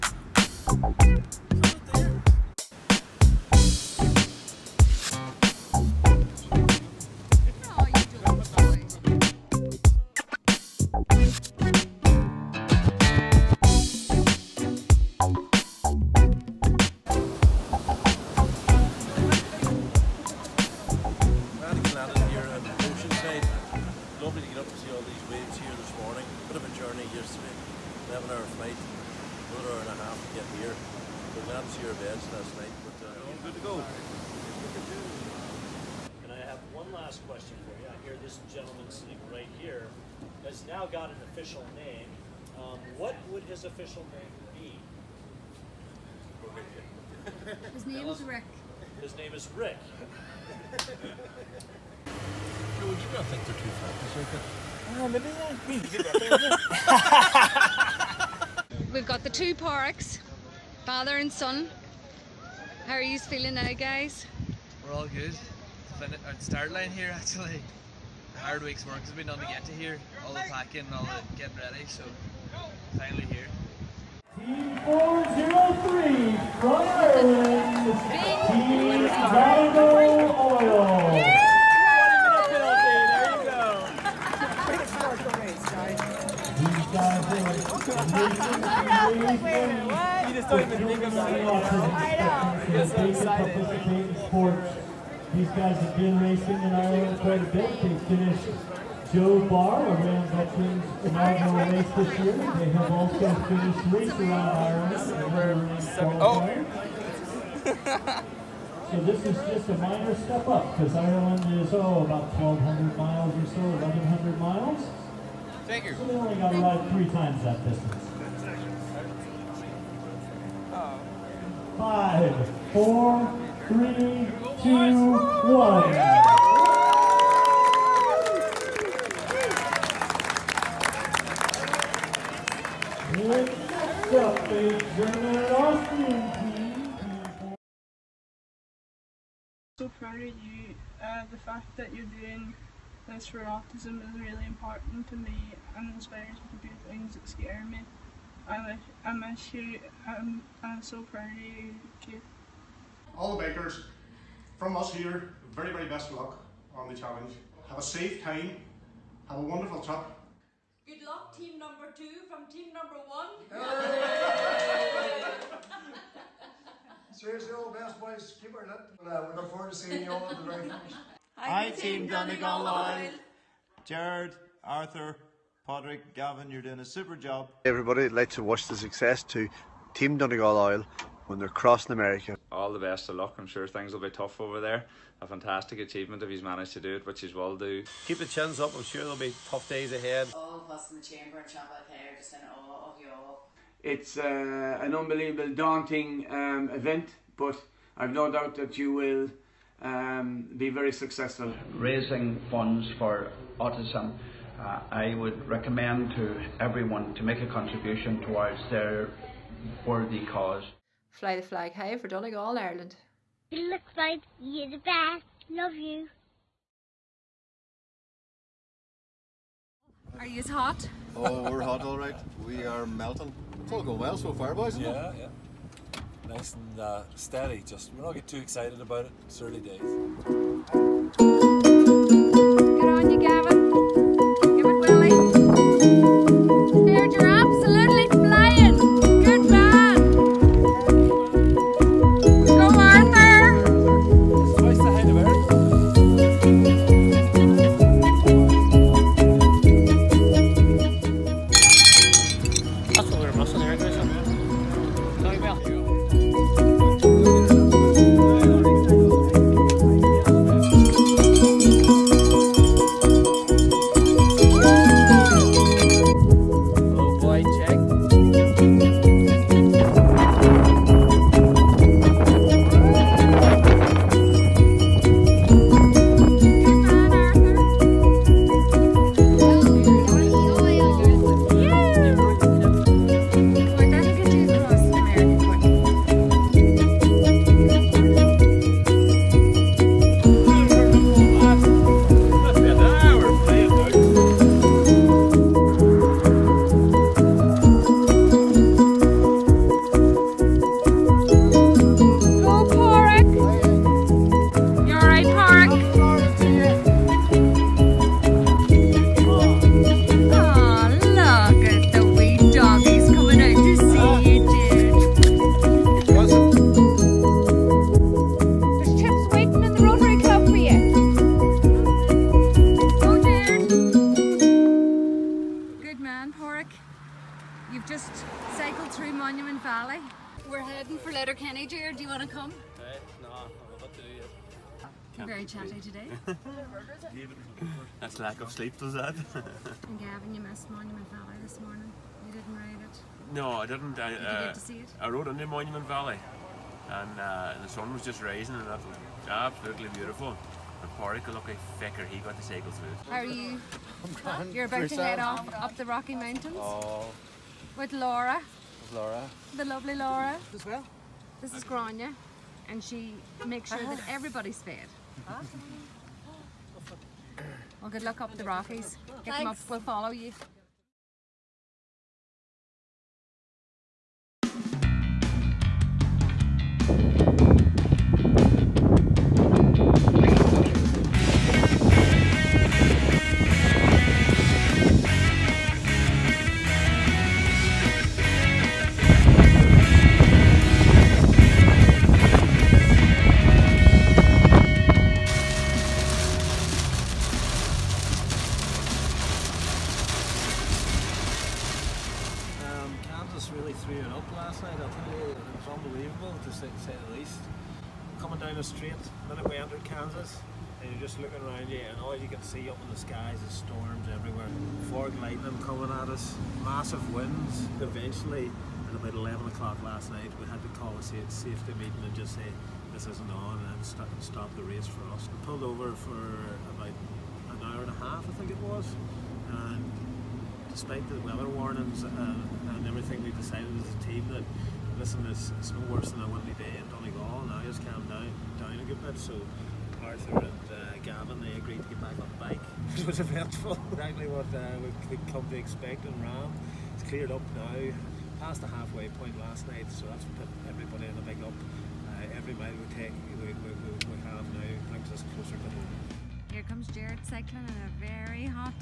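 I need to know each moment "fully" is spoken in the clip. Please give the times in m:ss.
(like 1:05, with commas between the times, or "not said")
not said.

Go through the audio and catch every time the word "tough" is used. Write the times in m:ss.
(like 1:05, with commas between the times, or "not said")
3:04, 3:09.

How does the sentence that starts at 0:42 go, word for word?
Um, what would his official name be?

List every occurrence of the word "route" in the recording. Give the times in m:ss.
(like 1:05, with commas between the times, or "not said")
not said.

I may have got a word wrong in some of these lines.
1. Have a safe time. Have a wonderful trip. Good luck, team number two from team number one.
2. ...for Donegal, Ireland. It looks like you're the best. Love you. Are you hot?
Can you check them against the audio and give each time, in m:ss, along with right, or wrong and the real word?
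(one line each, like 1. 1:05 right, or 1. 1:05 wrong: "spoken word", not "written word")
1. 2:37 right
2. 3:31 right.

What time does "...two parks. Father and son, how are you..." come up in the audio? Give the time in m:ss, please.
0:59.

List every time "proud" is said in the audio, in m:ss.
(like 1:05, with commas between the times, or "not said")
2:19, 2:31.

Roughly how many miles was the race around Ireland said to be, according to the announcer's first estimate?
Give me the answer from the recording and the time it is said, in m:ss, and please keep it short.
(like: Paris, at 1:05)
1,200 miles, at 1:52.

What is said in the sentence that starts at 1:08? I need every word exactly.
hard week's work has been done to get to here.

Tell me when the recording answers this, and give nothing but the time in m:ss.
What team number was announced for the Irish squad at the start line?
1:14.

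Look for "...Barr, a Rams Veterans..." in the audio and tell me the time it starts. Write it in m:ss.
1:39.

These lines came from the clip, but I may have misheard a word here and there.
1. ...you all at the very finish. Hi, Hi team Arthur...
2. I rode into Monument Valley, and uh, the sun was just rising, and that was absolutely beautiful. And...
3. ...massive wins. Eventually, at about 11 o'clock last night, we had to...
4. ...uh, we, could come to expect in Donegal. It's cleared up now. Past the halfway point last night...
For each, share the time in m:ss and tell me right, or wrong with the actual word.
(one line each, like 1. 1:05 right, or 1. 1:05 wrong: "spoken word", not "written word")
1. 2:50 wrong: "Donegal", not "Arthur"
2. 5:44 right
3. 6:56 right
4. 7:24 wrong: "RAAM", not "Donegal".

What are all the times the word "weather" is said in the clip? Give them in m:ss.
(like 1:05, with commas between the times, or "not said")
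7:11.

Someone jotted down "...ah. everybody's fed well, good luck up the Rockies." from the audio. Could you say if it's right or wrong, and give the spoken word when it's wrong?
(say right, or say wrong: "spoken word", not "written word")
right.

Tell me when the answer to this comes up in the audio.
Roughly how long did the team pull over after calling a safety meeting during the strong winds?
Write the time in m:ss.
7:06.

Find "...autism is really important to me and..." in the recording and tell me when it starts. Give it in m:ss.
2:23.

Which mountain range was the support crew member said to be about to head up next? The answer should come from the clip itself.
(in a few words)
Rocky Mountains.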